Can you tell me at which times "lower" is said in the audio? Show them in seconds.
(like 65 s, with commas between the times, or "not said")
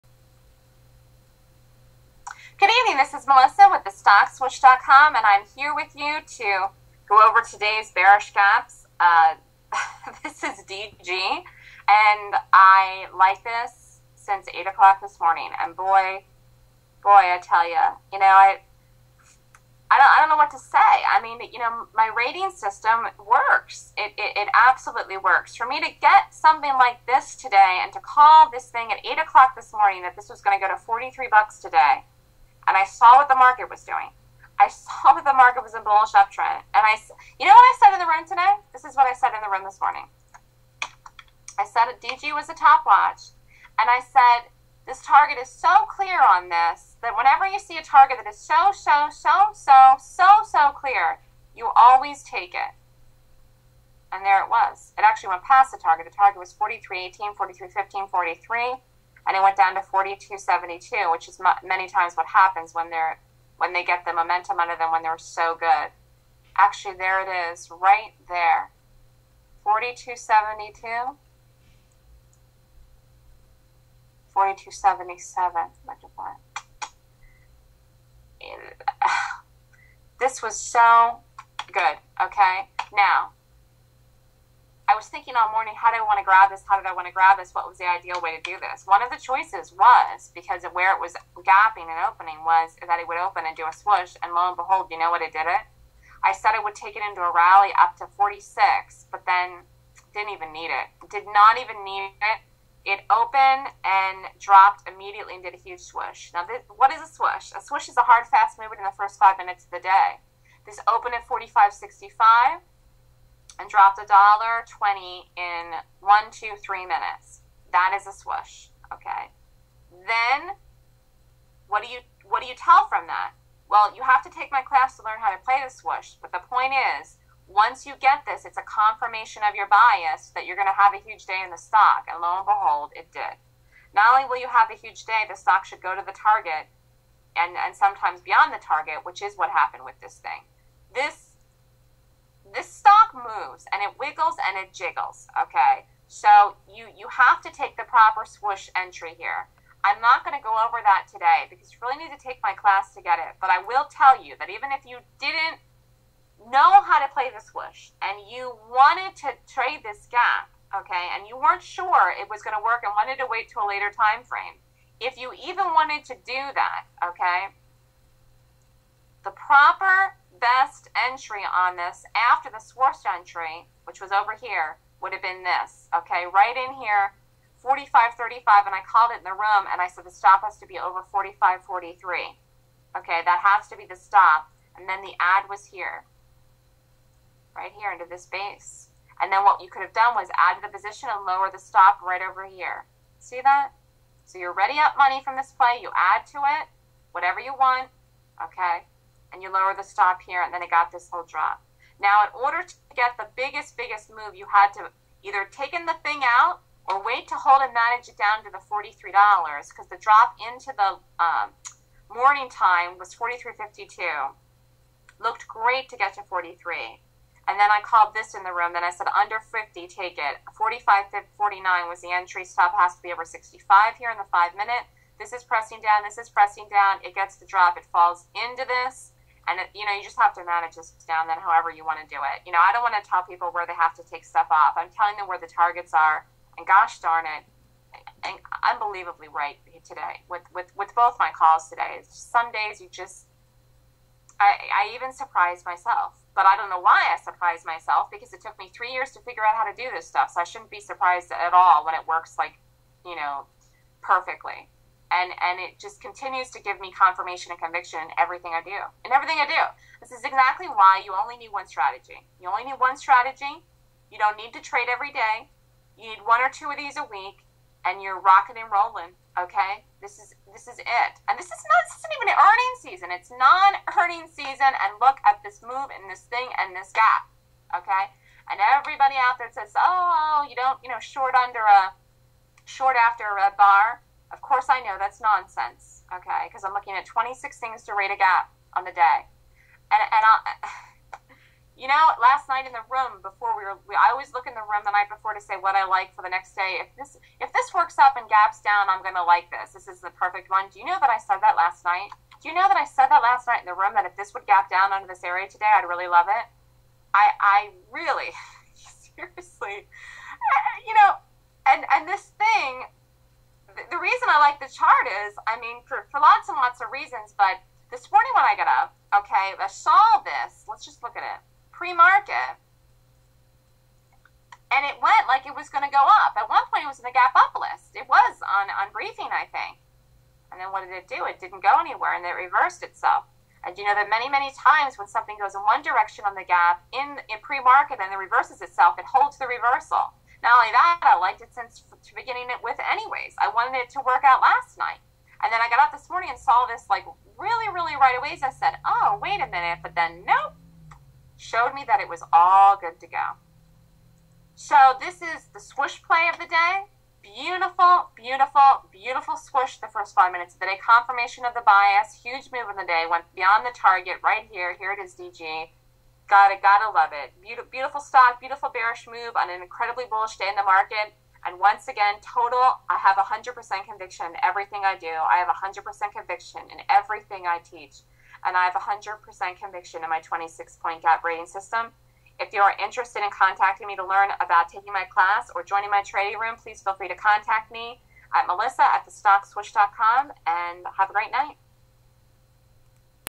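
191 s, 199 s.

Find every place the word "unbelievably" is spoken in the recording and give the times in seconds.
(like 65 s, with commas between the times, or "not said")
238 s.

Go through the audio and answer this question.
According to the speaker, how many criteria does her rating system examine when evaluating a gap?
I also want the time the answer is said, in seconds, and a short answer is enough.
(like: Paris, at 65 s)
26, at 287 s.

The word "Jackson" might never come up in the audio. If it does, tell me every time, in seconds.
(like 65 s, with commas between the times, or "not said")
not said.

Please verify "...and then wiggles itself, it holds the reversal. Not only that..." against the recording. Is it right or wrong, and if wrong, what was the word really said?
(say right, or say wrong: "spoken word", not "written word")
wrong: "reverses", not "wiggles".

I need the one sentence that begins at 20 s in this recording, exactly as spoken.
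I mean, you know, my rating system works.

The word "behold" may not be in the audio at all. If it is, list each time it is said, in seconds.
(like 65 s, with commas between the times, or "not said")
94 s, 132 s.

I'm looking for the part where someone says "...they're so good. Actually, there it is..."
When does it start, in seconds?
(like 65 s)
65 s.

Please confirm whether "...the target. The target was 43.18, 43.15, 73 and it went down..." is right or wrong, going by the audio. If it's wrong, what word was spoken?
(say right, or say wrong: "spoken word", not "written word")
wrong: "43", not "73".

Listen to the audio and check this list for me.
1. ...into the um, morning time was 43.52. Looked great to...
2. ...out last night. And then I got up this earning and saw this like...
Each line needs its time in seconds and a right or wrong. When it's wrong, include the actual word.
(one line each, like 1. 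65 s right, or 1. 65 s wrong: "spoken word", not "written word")
1. 210 s right
2. 344 s wrong: "morning", not "earning".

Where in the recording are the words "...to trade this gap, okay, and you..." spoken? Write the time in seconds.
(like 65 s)
159 s.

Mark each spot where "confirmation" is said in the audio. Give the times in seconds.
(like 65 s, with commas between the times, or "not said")
128 s, 256 s, 360 s.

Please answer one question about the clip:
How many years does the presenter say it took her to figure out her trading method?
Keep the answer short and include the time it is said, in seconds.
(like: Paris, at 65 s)
3, at 248 s.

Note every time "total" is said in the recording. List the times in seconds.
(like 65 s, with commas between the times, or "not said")
372 s.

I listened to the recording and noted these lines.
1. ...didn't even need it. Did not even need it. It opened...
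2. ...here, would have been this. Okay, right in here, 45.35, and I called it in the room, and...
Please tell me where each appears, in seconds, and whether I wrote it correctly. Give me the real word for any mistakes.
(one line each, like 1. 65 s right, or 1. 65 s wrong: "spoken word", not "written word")
1. 100 s right
2. 174 s right.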